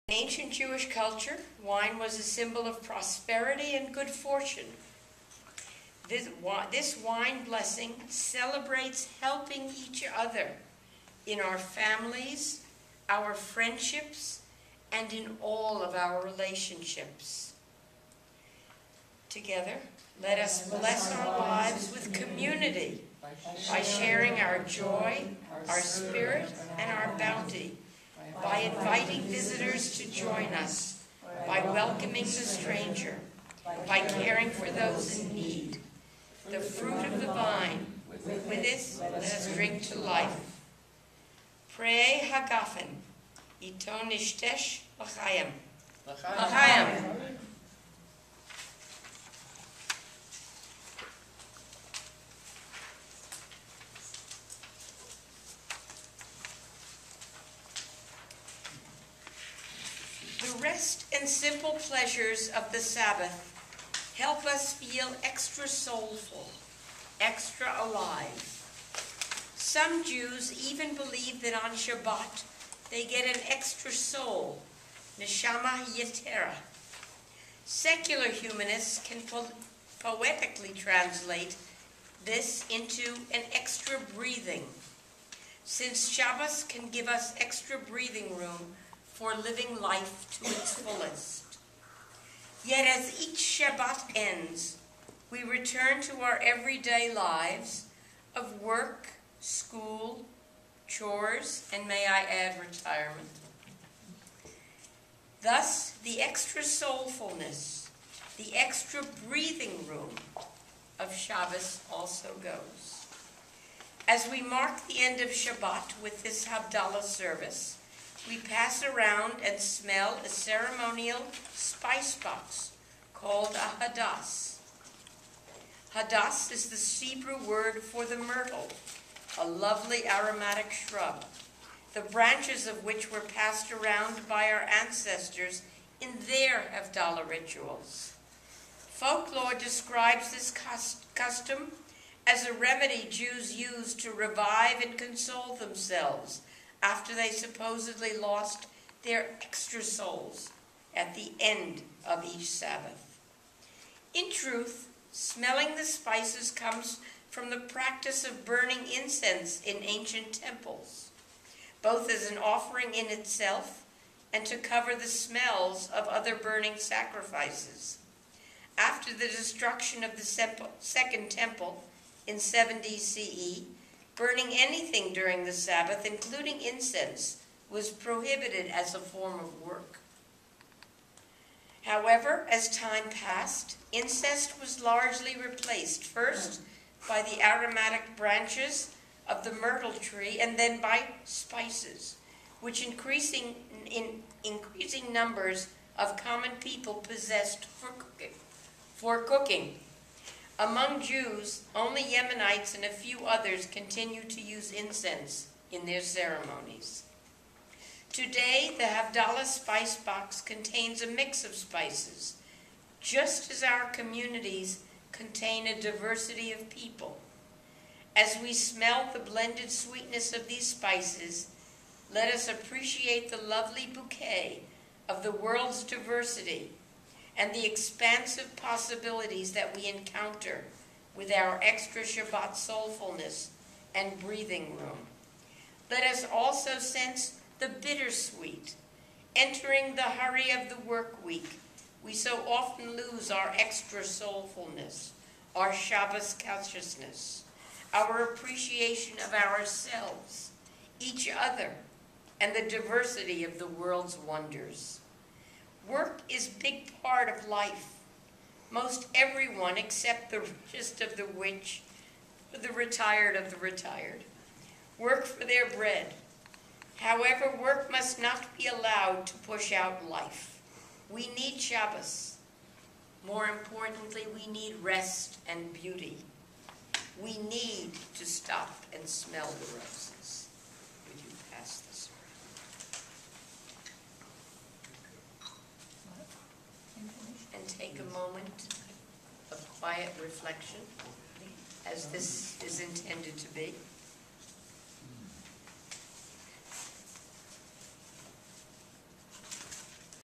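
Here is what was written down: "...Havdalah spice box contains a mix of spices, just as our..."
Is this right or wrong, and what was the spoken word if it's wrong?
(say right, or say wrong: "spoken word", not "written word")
right.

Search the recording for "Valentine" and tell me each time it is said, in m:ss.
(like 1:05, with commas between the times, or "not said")
not said.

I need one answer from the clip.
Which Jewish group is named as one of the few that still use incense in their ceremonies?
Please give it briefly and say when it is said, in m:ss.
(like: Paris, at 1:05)
Yemenites, at 3:22.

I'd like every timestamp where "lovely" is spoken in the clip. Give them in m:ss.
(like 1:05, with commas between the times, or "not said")
2:09, 3:43.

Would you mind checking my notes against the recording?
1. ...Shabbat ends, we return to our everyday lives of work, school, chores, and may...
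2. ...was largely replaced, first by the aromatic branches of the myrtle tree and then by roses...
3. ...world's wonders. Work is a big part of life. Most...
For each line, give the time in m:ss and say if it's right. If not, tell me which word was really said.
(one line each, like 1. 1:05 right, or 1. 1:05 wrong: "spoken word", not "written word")
1. 1:33 right
2. 3:04 wrong: "spices", not "roses"
3. 4:13 right.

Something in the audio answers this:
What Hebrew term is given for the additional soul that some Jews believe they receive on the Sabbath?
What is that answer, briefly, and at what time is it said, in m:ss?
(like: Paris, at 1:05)
neshama yetera, at 1:15.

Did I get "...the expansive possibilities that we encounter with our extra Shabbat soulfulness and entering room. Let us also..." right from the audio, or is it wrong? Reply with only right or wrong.
wrong.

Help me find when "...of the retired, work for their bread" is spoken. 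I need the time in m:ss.
4:23.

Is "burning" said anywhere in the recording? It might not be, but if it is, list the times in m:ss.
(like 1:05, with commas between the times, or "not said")
2:38, 2:46, 2:54.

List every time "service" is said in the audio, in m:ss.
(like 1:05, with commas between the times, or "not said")
1:57.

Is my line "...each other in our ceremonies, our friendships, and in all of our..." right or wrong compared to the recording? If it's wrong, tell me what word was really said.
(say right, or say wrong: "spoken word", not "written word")
wrong: "families", not "ceremonies".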